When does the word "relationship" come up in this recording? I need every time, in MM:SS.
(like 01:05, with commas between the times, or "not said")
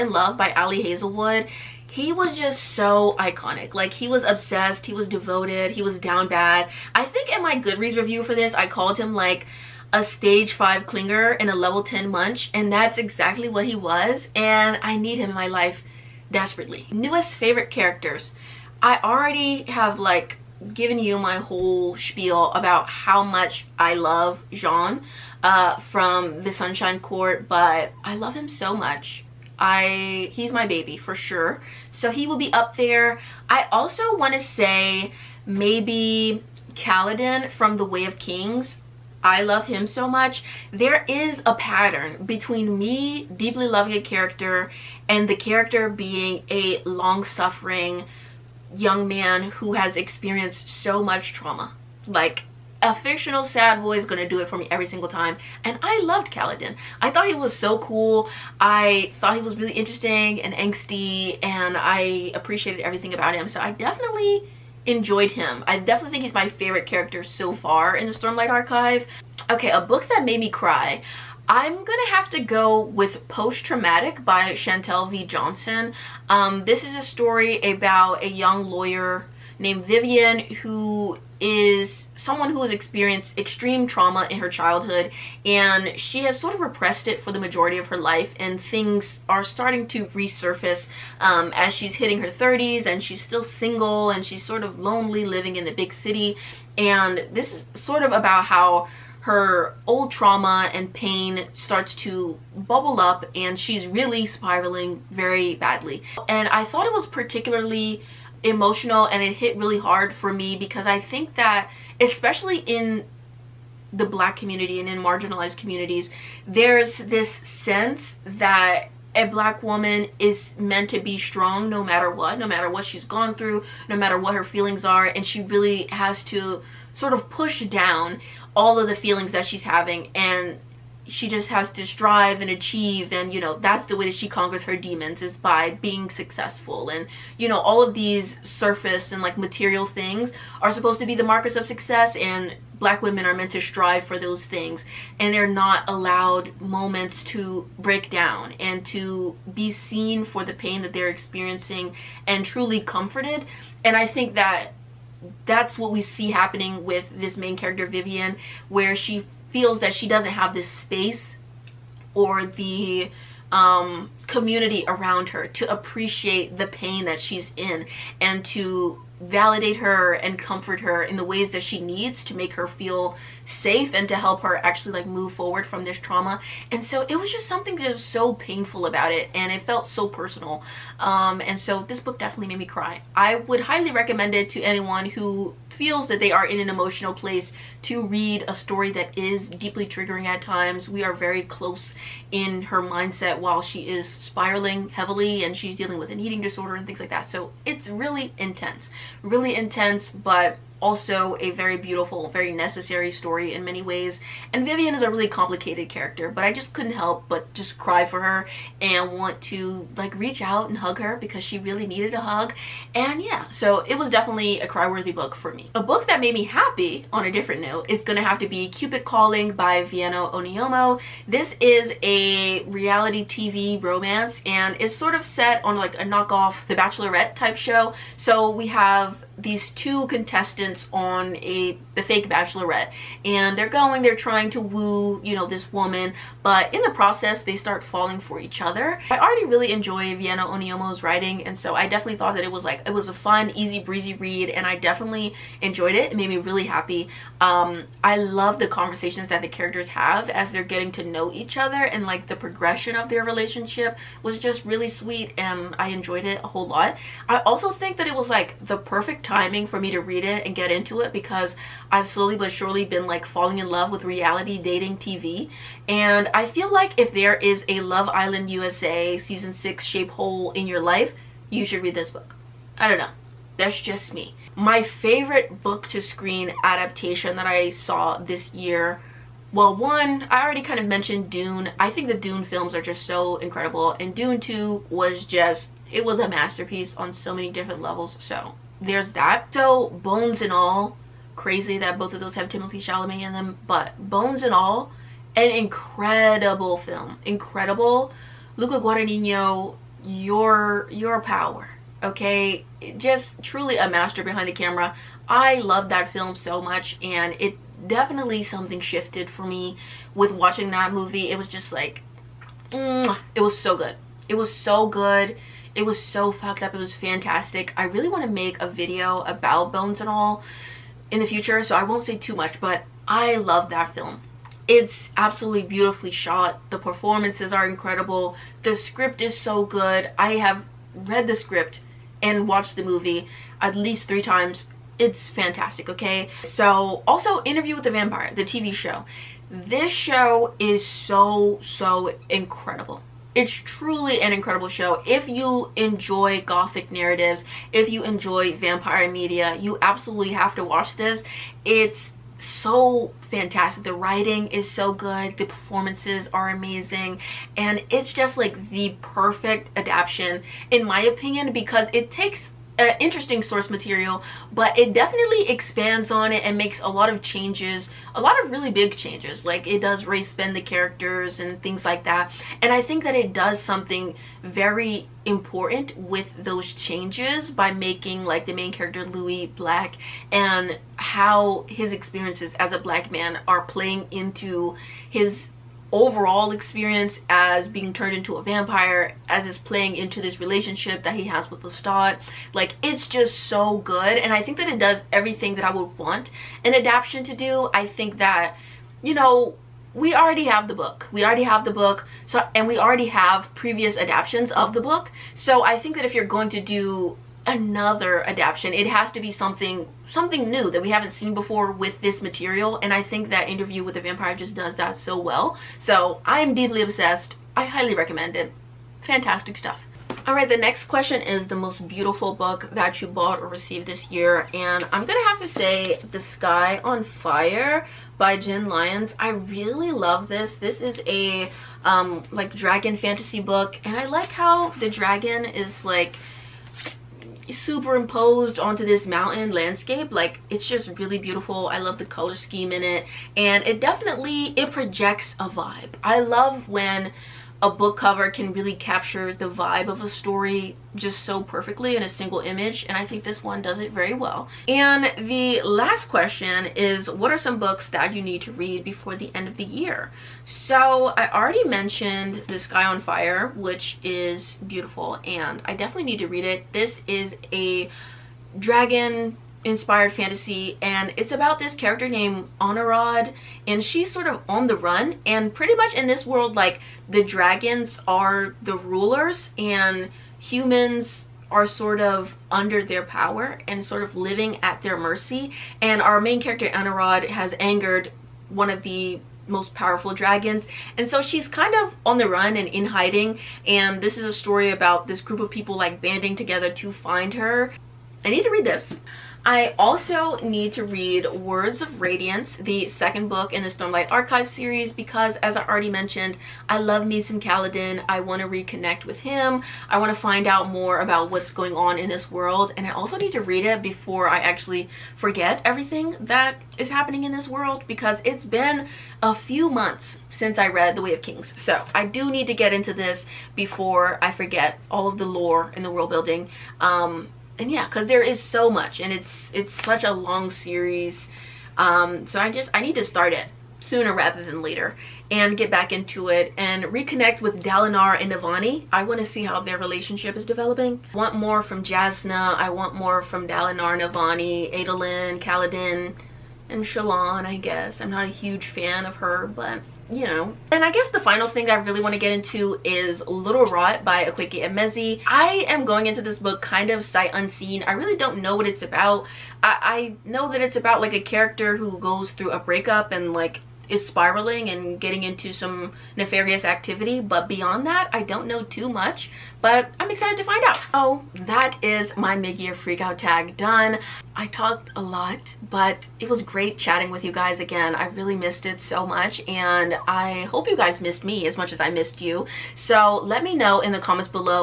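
04:13, 06:30, 08:59.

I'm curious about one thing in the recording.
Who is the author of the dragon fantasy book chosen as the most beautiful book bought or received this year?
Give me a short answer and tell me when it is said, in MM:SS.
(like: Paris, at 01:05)
Jenn Lyons, at 07:08.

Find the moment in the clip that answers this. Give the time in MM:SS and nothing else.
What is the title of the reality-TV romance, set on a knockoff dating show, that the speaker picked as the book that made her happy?
03:38.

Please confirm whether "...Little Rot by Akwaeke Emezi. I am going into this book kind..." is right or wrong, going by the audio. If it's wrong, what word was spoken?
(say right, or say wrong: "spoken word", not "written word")
right.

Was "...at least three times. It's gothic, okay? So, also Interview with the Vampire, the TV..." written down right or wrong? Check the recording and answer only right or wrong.
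wrong.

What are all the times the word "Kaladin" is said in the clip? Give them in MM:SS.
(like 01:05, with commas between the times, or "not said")
00:36, 00:56, 08:27, 09:05.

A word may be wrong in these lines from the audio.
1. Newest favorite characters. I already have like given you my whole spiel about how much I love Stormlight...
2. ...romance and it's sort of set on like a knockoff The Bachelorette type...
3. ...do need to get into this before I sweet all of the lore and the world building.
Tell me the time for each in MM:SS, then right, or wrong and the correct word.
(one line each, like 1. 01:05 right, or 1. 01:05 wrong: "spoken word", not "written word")
1. 00:16 wrong: "Jean", not "Stormlight"
2. 03:43 right
3. 08:42 wrong: "forget", not "sweet".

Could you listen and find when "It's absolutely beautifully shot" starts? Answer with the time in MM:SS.
05:24.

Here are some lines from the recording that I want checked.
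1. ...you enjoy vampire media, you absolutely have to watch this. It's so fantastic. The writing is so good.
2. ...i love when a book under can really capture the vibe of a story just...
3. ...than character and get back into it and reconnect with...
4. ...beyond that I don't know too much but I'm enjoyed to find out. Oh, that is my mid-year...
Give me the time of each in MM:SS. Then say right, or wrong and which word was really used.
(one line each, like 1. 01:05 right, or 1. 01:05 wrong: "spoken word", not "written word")
1. 05:47 right
2. 07:26 wrong: "cover", not "under"
3. 08:54 wrong: "later", not "character"
4. 09:27 wrong: "excited", not "enjoyed".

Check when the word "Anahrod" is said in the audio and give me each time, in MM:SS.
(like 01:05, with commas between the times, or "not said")
07:52, 08:06.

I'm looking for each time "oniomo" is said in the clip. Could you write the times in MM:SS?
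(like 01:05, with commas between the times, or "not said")
03:40, 04:00.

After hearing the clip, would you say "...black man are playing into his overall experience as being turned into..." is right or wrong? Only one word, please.
right.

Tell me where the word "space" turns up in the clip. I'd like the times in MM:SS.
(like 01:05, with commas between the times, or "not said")
02:40.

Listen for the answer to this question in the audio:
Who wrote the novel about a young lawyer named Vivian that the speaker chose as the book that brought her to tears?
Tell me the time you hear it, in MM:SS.
01:14.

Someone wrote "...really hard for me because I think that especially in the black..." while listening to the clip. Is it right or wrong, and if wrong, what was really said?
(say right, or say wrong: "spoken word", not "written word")
right.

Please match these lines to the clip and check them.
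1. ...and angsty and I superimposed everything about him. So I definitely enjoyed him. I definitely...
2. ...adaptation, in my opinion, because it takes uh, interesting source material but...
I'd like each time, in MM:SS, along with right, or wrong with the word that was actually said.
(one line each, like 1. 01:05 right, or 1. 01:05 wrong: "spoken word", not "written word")
1. 01:00 wrong: "appreciated", not "superimposed"
2. 05:59 right.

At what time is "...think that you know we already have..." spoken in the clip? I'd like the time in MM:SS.
06:37.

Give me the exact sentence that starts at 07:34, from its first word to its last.
And the last question is what are some books that you need to read before the end of the year?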